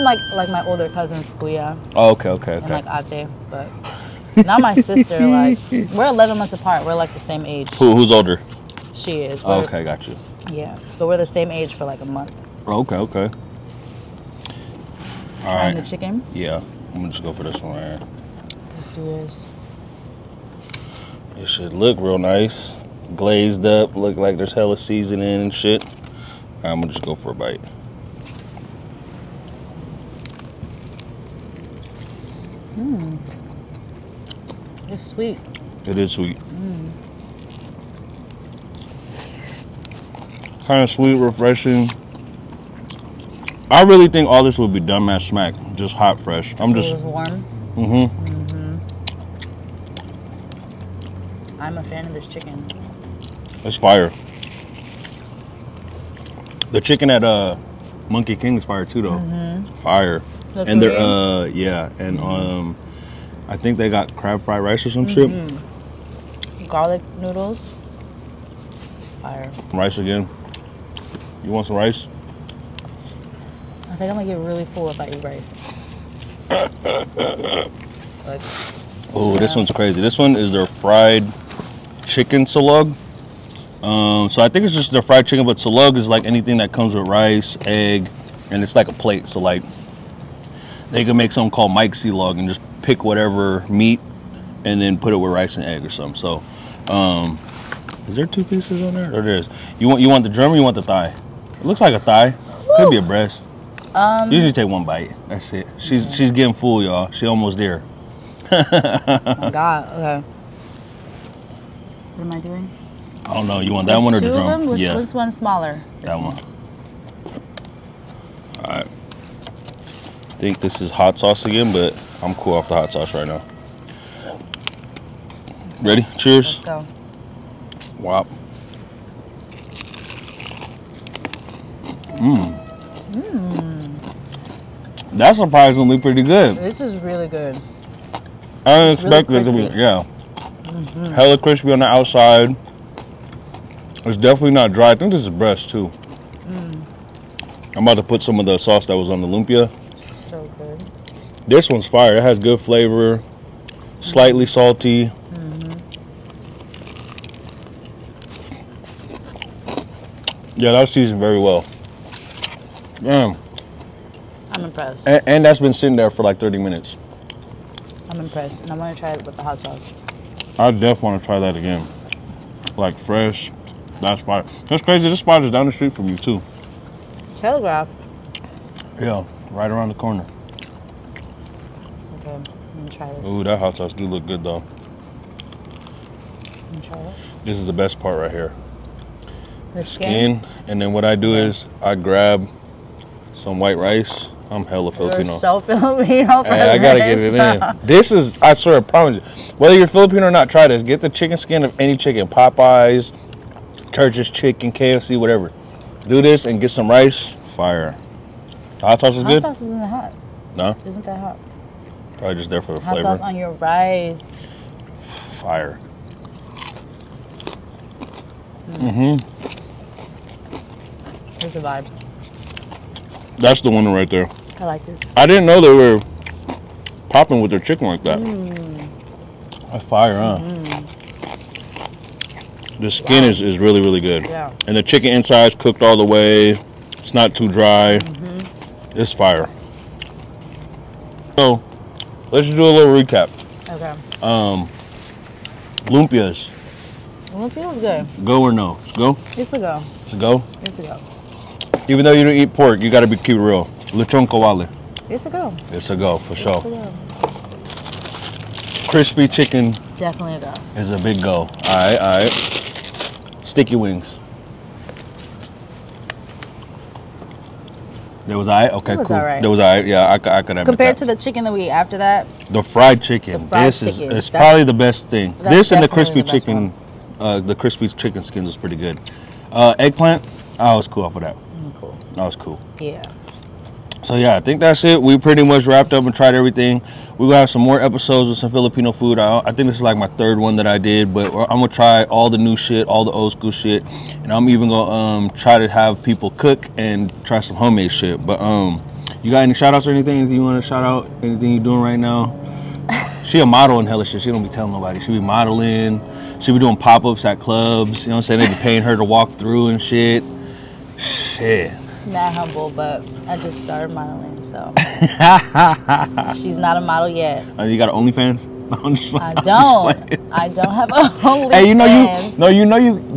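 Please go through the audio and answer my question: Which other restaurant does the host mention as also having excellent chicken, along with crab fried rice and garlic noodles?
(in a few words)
Monkey King.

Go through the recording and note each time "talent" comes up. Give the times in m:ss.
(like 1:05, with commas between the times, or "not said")
not said.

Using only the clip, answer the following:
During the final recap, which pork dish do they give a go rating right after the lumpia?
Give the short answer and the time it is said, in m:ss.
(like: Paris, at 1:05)
Lechon kawali, at 4:13.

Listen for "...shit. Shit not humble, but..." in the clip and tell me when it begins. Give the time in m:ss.
5:09.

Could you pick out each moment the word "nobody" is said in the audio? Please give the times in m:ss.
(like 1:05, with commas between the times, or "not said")
5:04.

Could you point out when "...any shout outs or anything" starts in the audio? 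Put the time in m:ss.
4:59.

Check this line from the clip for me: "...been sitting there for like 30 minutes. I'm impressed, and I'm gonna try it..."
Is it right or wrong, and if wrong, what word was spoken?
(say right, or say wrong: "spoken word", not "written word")
right.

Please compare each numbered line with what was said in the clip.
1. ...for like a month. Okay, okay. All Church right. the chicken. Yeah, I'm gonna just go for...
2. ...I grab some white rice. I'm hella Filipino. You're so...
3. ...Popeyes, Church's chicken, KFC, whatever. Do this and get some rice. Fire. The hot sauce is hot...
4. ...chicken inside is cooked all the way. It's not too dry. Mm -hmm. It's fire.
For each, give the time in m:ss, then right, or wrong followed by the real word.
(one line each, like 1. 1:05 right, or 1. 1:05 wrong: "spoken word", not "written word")
1. 0:11 wrong: "Trying", not "Church"
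2. 3:11 right
3. 3:22 right
4. 3:54 right.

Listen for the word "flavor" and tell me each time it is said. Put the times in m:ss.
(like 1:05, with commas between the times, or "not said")
2:32, 3:32.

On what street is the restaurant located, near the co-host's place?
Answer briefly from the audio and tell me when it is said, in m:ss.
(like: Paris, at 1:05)
Telegraph, at 2:57.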